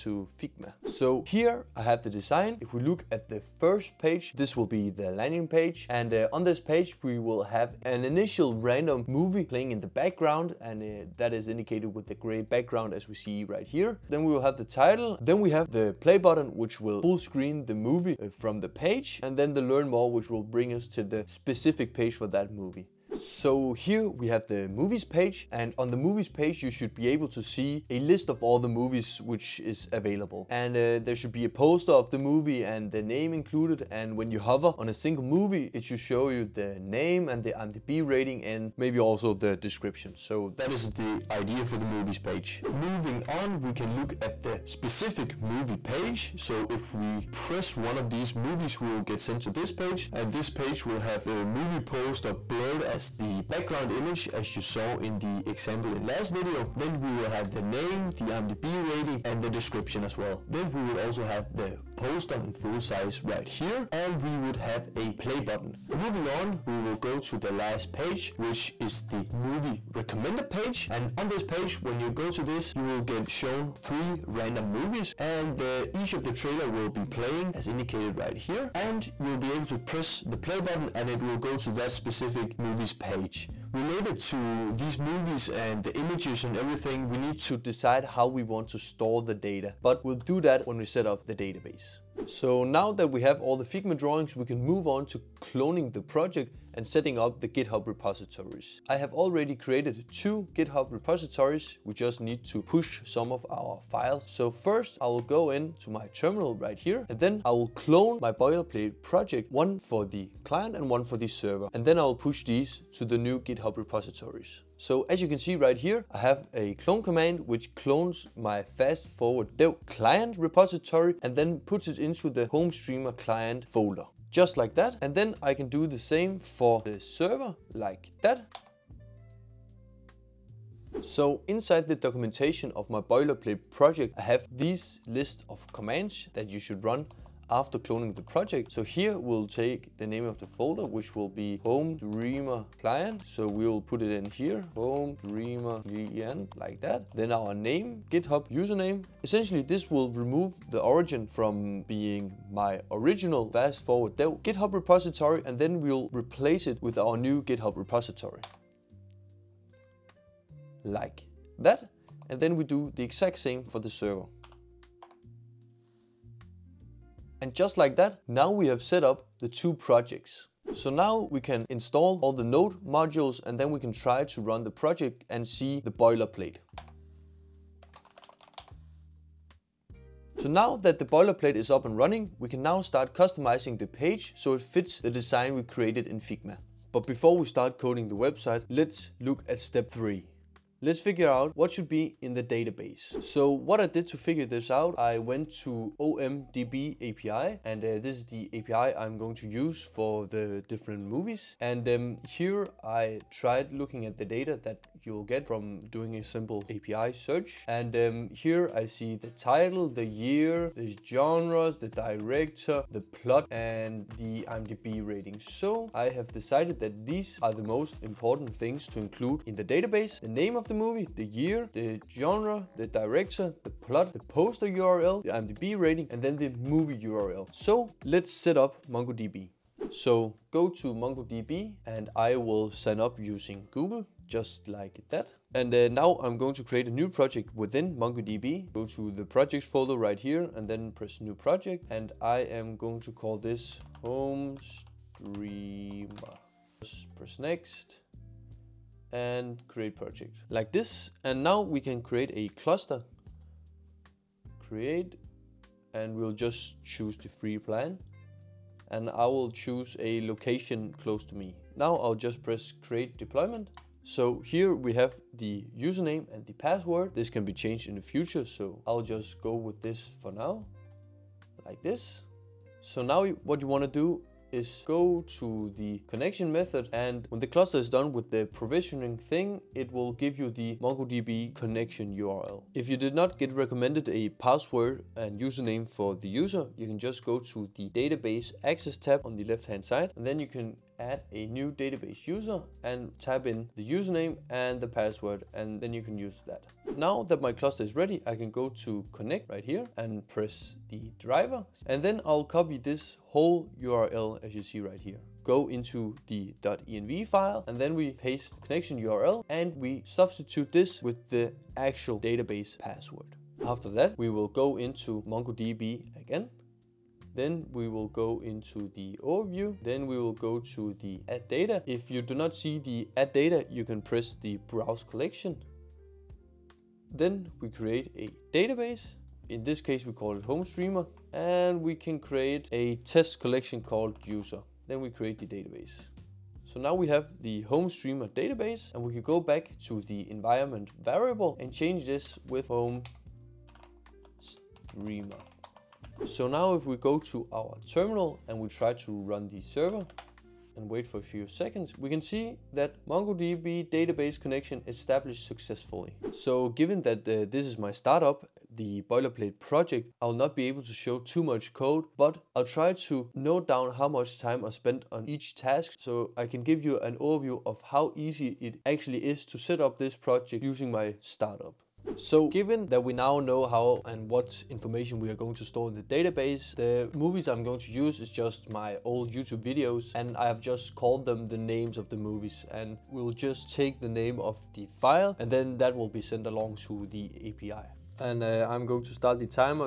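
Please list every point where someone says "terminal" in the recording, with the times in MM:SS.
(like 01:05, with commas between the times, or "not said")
01:46, 05:47.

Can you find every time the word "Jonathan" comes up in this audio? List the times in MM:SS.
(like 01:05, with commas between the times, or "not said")
not said.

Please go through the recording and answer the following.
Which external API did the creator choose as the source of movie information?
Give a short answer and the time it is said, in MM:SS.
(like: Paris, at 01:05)
OMDB API, at 03:15.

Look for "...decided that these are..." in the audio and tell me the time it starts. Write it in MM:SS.
03:36.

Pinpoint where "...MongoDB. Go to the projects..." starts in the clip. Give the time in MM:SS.
03:57.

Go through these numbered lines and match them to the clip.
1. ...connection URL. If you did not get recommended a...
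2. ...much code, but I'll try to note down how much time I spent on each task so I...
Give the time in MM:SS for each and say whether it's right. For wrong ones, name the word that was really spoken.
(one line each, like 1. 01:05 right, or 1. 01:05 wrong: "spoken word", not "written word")
1. 04:41 right
2. 06:01 right.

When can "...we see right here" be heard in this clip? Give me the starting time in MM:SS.
00:13.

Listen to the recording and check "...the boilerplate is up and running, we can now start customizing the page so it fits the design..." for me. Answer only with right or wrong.
right.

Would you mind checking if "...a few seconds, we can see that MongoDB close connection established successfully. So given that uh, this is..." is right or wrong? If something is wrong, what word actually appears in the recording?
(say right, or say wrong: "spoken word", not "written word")
wrong: "database", not "close".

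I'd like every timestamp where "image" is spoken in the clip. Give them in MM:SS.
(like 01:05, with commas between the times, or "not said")
00:53, 01:25.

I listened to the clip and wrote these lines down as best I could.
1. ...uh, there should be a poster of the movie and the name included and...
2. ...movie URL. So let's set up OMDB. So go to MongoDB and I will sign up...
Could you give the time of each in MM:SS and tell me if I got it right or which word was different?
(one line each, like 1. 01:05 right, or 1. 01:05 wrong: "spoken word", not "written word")
1. 00:30 right
2. 03:46 wrong: "MongoDB", not "OMDB".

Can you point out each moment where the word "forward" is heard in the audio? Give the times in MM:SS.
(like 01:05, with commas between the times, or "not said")
01:59, 02:33.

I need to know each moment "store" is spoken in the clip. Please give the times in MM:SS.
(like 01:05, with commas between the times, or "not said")
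01:28, 06:15.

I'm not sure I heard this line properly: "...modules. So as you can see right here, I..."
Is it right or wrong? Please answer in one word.
wrong.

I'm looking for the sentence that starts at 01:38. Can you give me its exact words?
I have already created two GitHub repositories.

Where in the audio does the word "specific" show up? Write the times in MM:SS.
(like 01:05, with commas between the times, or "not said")
00:21, 00:44, 01:21.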